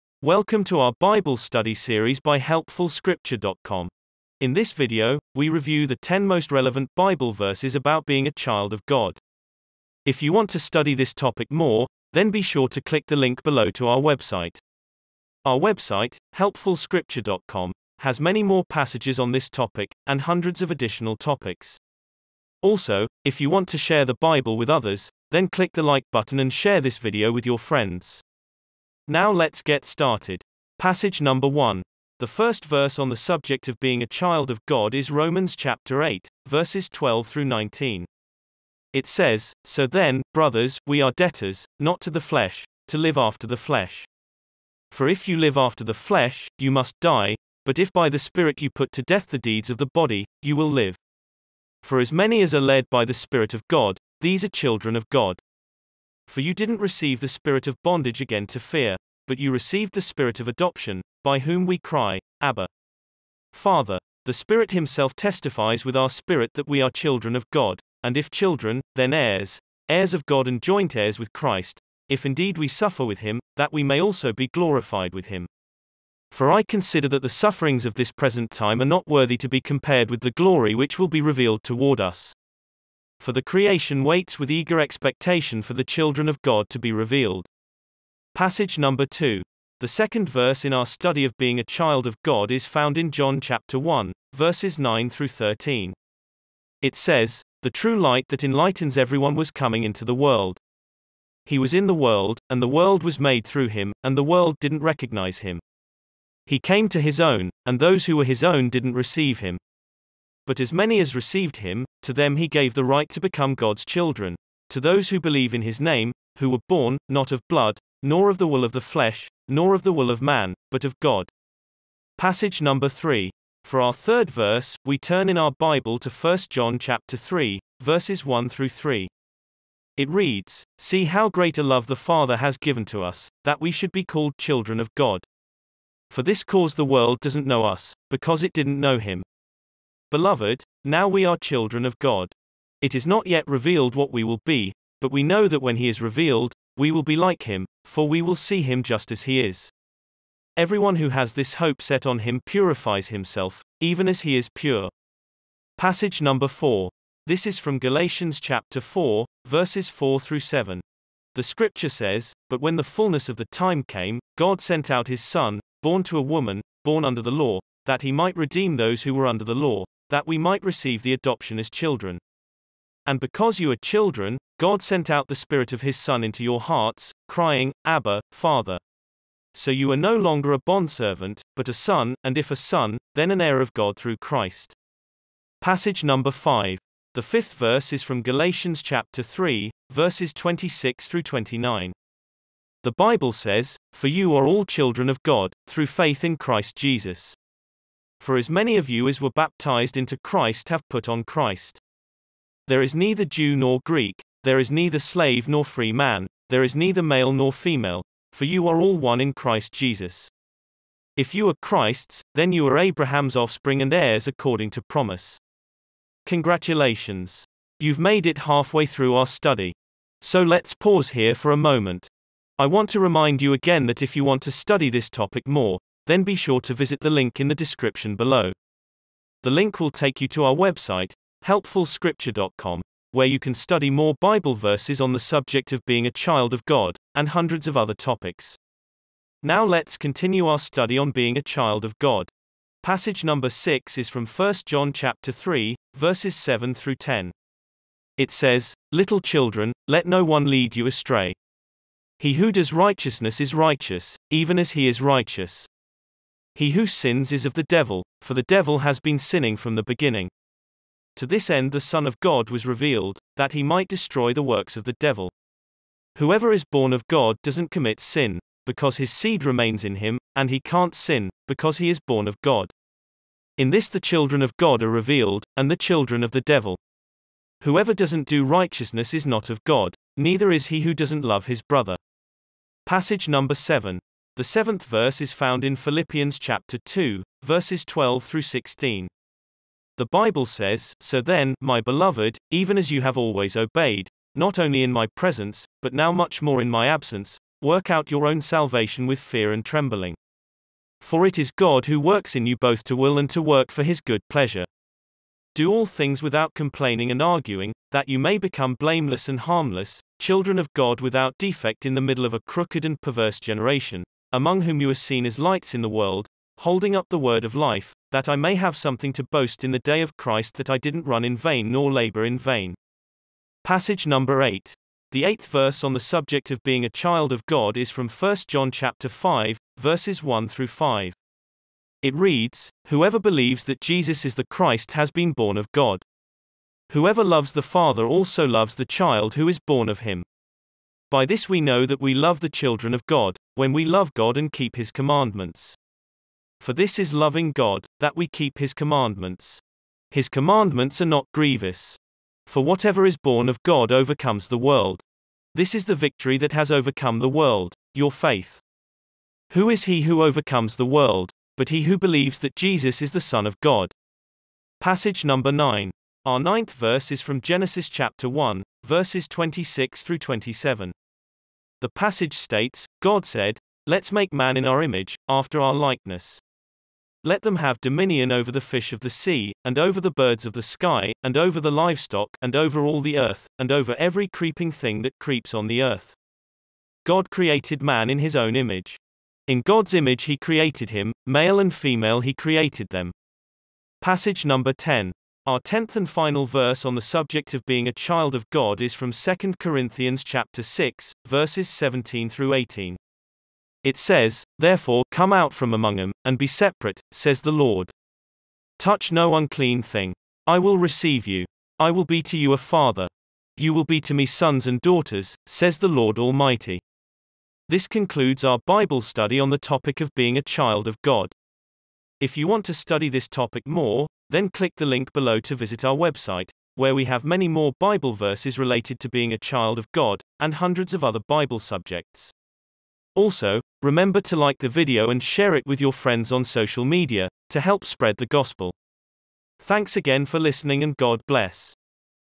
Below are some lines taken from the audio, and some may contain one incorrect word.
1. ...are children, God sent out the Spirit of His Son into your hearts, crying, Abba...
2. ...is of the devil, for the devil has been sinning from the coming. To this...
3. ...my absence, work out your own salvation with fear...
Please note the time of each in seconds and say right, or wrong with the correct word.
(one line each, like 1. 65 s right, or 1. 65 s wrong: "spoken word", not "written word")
1. 173 s right
2. 257 s wrong: "beginning", not "coming"
3. 296 s right.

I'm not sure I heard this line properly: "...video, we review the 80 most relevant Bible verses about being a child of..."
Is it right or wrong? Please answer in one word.
wrong.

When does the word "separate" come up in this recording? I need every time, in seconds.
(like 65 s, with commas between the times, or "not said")
406 s.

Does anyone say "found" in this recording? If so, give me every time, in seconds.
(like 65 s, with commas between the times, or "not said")
92 s, 285 s.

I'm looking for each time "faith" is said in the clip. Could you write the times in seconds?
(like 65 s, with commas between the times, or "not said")
195 s, 358 s.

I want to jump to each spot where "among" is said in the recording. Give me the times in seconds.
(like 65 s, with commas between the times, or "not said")
314 s, 405 s.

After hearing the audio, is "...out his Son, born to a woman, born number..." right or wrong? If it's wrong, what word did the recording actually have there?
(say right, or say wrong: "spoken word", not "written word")
wrong: "under", not "number".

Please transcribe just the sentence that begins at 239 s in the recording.
Now let's continue our study on being a child of God.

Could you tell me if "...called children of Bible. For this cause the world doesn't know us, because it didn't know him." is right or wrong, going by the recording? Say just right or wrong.
wrong.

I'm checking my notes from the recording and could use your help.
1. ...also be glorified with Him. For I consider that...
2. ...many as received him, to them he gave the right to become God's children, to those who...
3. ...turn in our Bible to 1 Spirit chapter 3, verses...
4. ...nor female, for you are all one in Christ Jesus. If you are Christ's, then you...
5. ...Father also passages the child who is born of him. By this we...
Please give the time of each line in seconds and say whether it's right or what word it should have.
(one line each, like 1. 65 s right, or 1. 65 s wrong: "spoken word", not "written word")
1. 73 s right
2. 110 s right
3. 124 s wrong: "John", not "Spirit"
4. 207 s right
5. 337 s wrong: "loves", not "passages".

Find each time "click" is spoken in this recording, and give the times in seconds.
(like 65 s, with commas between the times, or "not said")
12 s, 25 s, 424 s.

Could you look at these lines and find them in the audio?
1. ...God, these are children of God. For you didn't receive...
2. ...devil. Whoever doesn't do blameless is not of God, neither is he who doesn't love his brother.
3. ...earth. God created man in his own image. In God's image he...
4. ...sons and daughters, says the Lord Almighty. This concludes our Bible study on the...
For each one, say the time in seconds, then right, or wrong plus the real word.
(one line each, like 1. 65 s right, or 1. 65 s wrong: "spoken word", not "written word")
1. 53 s right
2. 276 s wrong: "righteousness", not "blameless"
3. 385 s right
4. 414 s right.